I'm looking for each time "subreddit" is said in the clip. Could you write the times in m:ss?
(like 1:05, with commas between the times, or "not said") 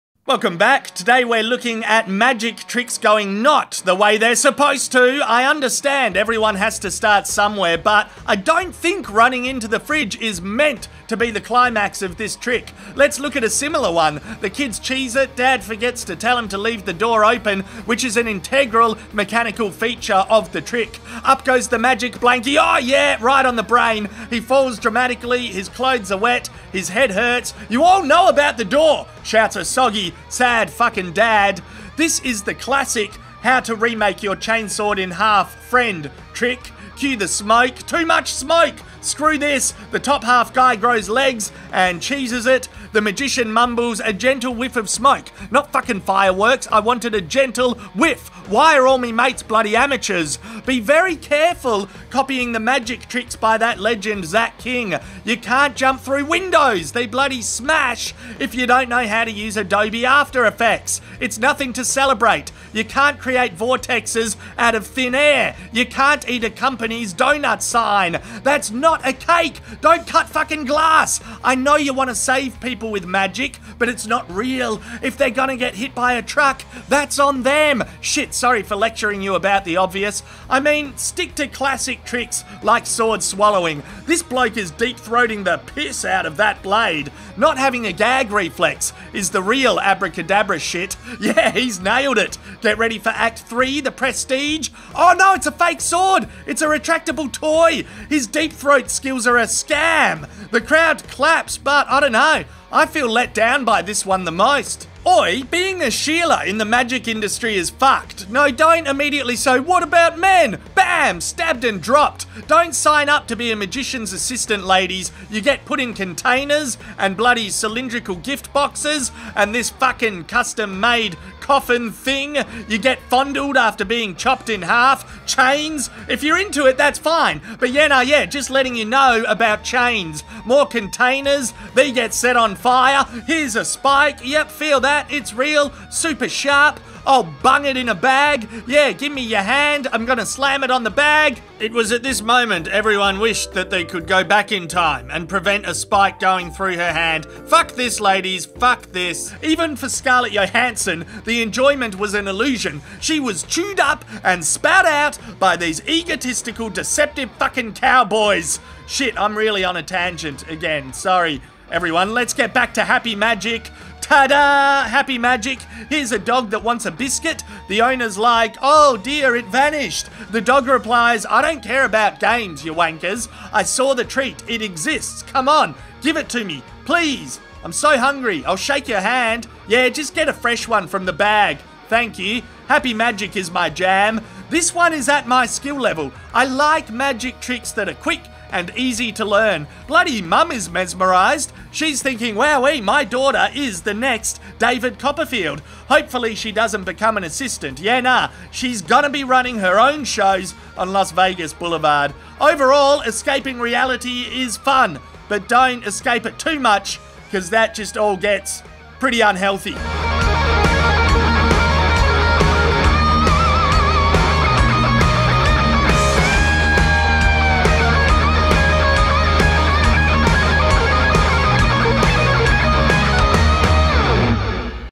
not said.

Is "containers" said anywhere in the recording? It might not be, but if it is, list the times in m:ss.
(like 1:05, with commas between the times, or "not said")
1:55, 2:10.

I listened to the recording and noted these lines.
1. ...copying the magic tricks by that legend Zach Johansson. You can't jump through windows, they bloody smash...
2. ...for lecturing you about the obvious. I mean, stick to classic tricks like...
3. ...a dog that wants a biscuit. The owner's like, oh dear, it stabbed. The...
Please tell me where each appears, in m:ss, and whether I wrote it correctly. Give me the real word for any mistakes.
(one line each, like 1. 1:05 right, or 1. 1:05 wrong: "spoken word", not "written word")
1. 0:52 wrong: "King", not "Johansson"
2. 1:18 right
3. 2:46 wrong: "vanished", not "stabbed".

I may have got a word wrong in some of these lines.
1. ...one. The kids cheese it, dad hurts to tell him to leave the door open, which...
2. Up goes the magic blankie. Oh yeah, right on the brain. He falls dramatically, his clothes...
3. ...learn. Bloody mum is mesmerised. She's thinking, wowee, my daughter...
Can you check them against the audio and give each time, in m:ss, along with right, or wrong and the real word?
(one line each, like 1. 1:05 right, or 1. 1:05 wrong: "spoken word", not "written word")
1. 0:13 wrong: "forgets", not "hurts"
2. 0:21 right
3. 3:09 right.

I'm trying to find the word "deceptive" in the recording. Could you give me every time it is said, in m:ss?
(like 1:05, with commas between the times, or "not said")
2:36.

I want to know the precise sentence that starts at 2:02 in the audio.
You get fondled after being chopped in half.